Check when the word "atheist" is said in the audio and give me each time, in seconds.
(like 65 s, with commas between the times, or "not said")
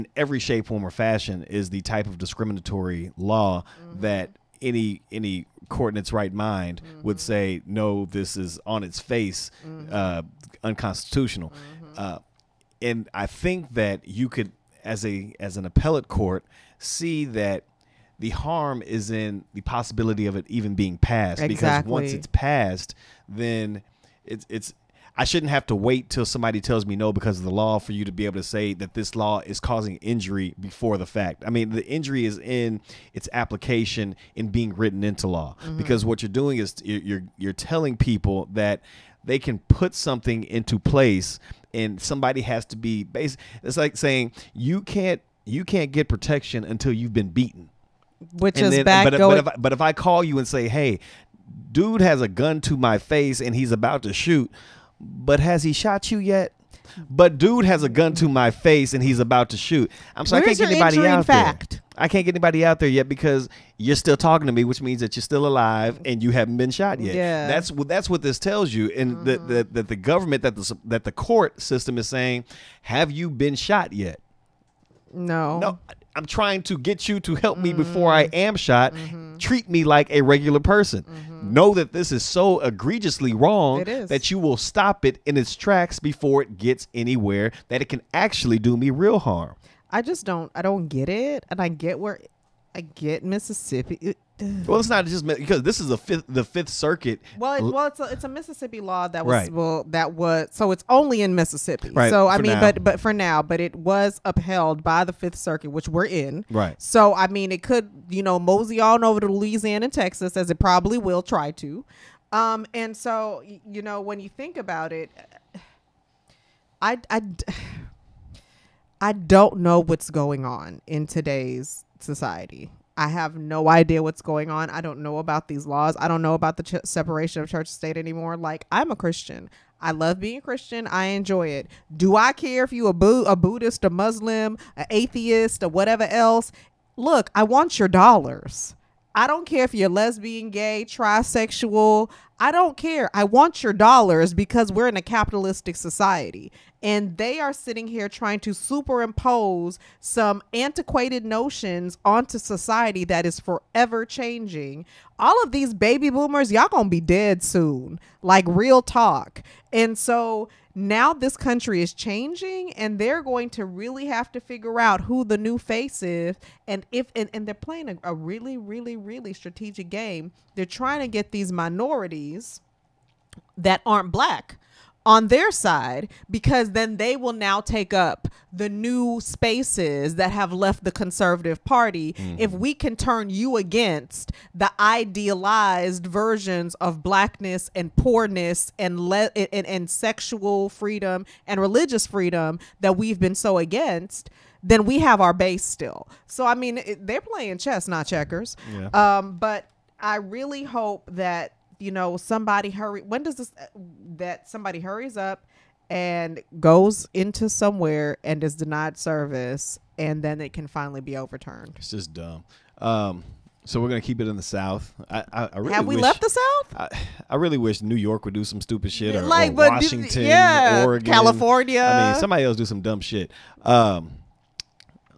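134 s.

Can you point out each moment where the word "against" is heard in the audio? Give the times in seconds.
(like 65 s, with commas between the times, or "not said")
183 s, 193 s.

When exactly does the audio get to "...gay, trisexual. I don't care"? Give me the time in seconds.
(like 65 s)
140 s.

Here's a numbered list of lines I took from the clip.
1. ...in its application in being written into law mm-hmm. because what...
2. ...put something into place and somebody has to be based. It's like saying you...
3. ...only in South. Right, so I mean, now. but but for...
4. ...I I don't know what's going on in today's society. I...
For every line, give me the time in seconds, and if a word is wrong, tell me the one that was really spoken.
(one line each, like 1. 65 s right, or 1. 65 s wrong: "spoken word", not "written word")
1. 32 s right
2. 39 s right
3. 100 s wrong: "Mississippi", not "South"
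4. 117 s right.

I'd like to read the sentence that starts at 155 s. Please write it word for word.
All of these baby boomers, y'all gonna be dead soon, like real talk.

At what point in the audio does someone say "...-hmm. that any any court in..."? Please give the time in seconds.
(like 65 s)
3 s.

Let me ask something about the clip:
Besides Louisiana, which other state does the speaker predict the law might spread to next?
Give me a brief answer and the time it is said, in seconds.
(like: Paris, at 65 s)
Texas, at 109 s.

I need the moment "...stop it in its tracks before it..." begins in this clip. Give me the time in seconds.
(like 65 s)
84 s.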